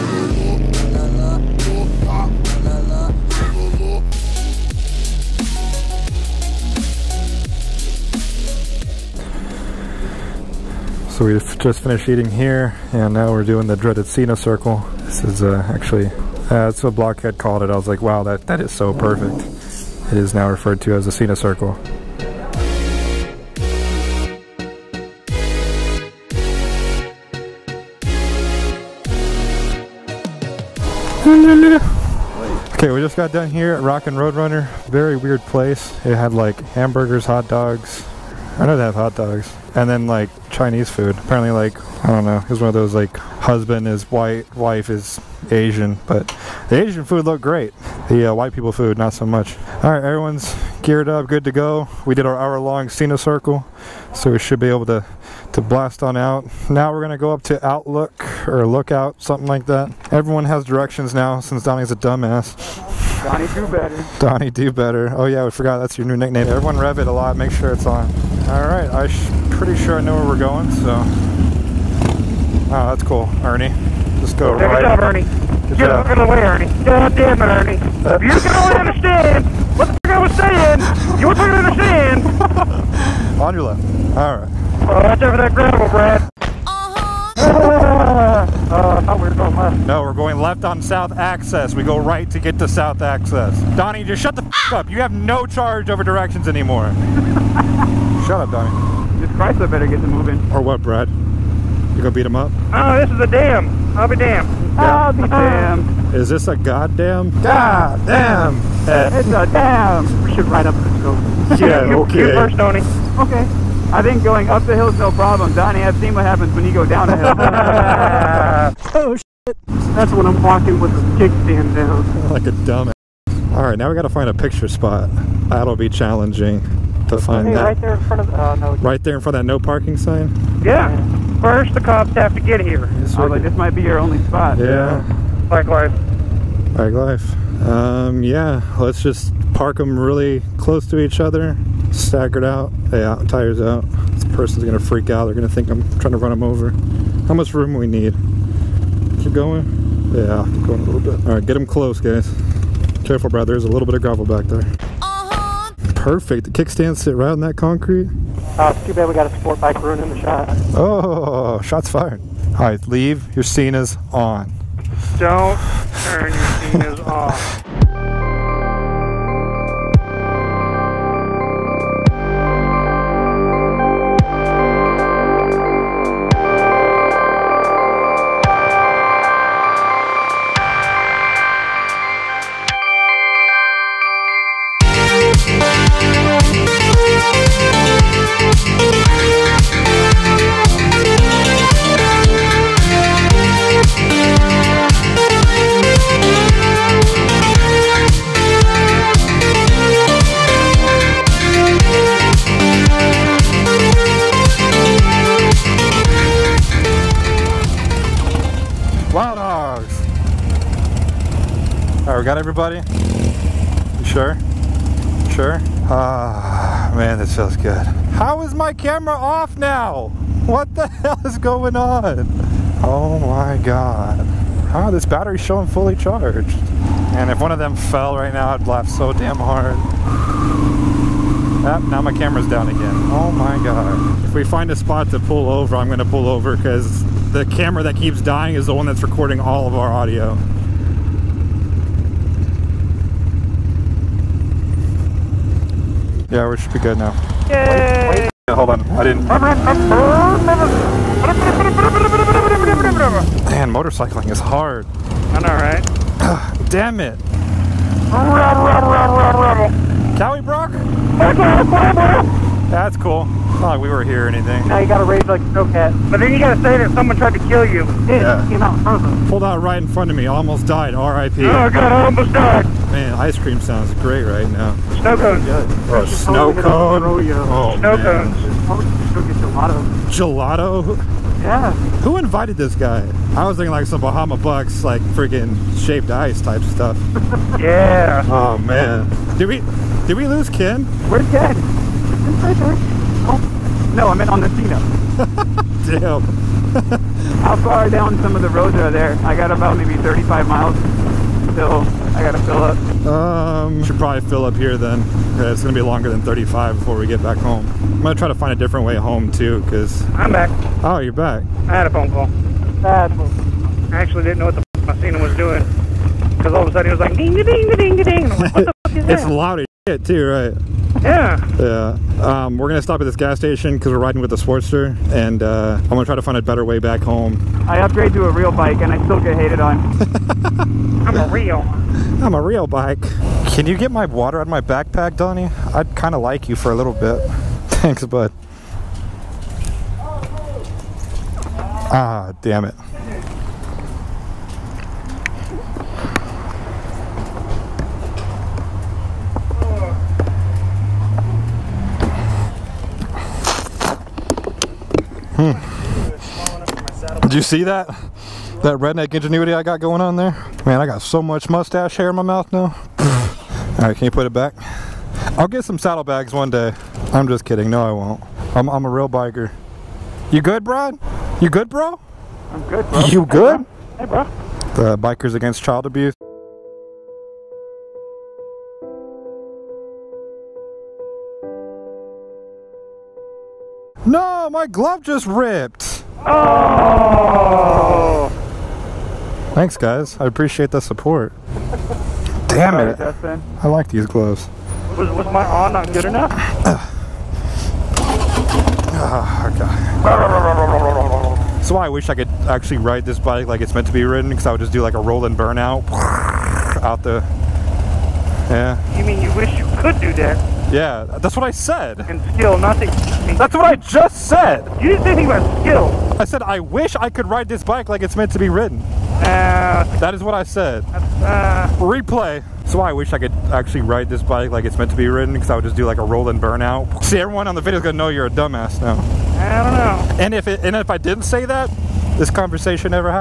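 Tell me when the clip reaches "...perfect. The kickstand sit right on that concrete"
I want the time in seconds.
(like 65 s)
156 s.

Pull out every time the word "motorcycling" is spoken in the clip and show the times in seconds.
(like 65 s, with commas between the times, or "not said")
253 s.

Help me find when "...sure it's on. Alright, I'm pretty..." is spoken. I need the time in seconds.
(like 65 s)
67 s.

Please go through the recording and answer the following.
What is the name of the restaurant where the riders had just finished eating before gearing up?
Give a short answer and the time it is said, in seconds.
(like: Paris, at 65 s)
Rockin' Roadrunner, at 33 s.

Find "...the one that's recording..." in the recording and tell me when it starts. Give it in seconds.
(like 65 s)
238 s.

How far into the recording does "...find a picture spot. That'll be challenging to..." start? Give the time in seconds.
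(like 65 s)
124 s.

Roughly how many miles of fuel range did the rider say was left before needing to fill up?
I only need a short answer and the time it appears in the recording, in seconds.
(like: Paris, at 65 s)
35, at 300 s.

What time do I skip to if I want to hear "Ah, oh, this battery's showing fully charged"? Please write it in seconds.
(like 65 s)
224 s.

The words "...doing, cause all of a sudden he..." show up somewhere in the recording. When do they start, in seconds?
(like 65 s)
315 s.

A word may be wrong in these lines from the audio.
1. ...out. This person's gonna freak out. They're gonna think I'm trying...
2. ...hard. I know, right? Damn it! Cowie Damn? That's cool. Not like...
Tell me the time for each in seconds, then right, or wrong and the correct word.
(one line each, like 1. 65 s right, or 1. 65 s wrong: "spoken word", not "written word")
1. 143 s right
2. 254 s wrong: "Brock", not "Damn".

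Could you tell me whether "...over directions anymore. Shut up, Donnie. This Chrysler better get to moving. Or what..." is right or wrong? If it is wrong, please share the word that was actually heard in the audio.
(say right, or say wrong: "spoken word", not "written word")
right.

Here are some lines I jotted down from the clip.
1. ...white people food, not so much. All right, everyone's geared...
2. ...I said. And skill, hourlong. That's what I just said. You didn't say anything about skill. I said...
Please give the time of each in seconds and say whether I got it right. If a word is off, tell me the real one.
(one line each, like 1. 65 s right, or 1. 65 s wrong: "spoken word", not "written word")
1. 48 s right
2. 411 s wrong: "nothing", not "hourlong".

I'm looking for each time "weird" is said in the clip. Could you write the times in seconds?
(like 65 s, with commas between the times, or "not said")
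35 s.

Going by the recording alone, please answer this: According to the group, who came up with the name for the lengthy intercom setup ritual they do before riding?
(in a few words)
Blockhead.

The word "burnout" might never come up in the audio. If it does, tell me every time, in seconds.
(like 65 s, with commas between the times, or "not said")
405 s, 426 s.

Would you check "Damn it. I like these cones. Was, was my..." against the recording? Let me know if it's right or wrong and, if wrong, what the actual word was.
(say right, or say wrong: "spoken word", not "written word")
wrong: "gloves", not "cones".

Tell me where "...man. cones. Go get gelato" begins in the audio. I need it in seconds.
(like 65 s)
277 s.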